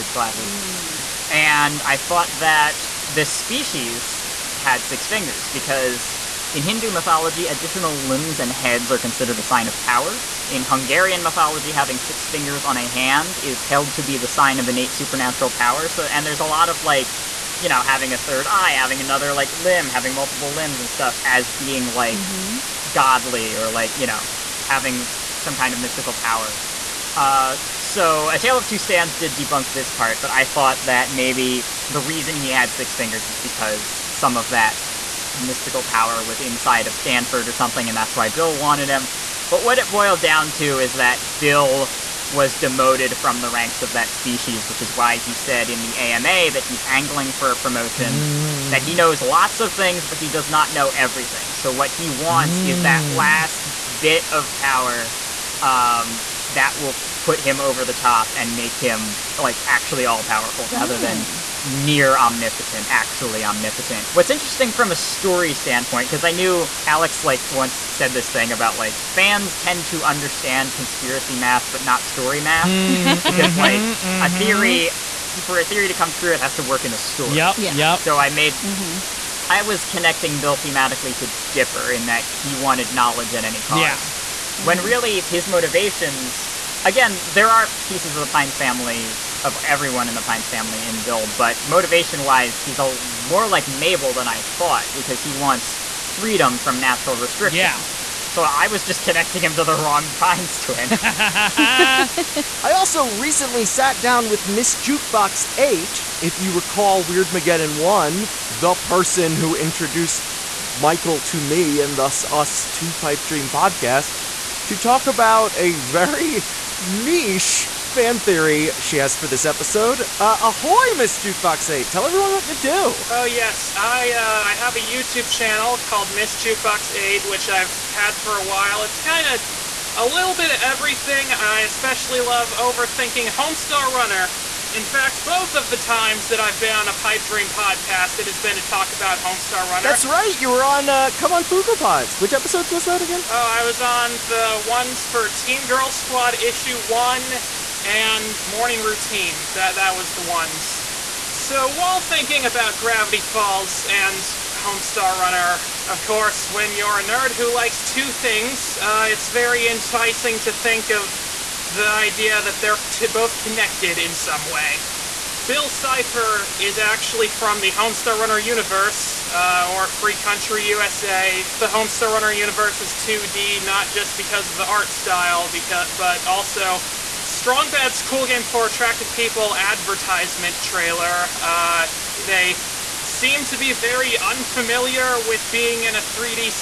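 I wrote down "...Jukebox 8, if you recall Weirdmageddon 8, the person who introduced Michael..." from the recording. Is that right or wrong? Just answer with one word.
wrong.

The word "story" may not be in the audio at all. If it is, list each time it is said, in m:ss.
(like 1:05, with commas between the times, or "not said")
1:04, 1:12, 1:16.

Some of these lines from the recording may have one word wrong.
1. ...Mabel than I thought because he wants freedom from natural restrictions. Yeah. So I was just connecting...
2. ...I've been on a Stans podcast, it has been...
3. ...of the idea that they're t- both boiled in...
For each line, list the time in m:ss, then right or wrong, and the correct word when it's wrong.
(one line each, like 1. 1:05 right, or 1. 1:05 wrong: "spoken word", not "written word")
1. 1:33 right
2. 2:16 wrong: "Pipedream", not "Stans"
3. 2:40 wrong: "connected", not "boiled".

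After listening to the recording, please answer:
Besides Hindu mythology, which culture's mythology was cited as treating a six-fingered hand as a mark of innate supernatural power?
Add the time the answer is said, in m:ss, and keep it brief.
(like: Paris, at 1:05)
Hungarian, at 0:10.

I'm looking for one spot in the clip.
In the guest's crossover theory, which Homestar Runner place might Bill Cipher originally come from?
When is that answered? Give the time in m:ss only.
2:49.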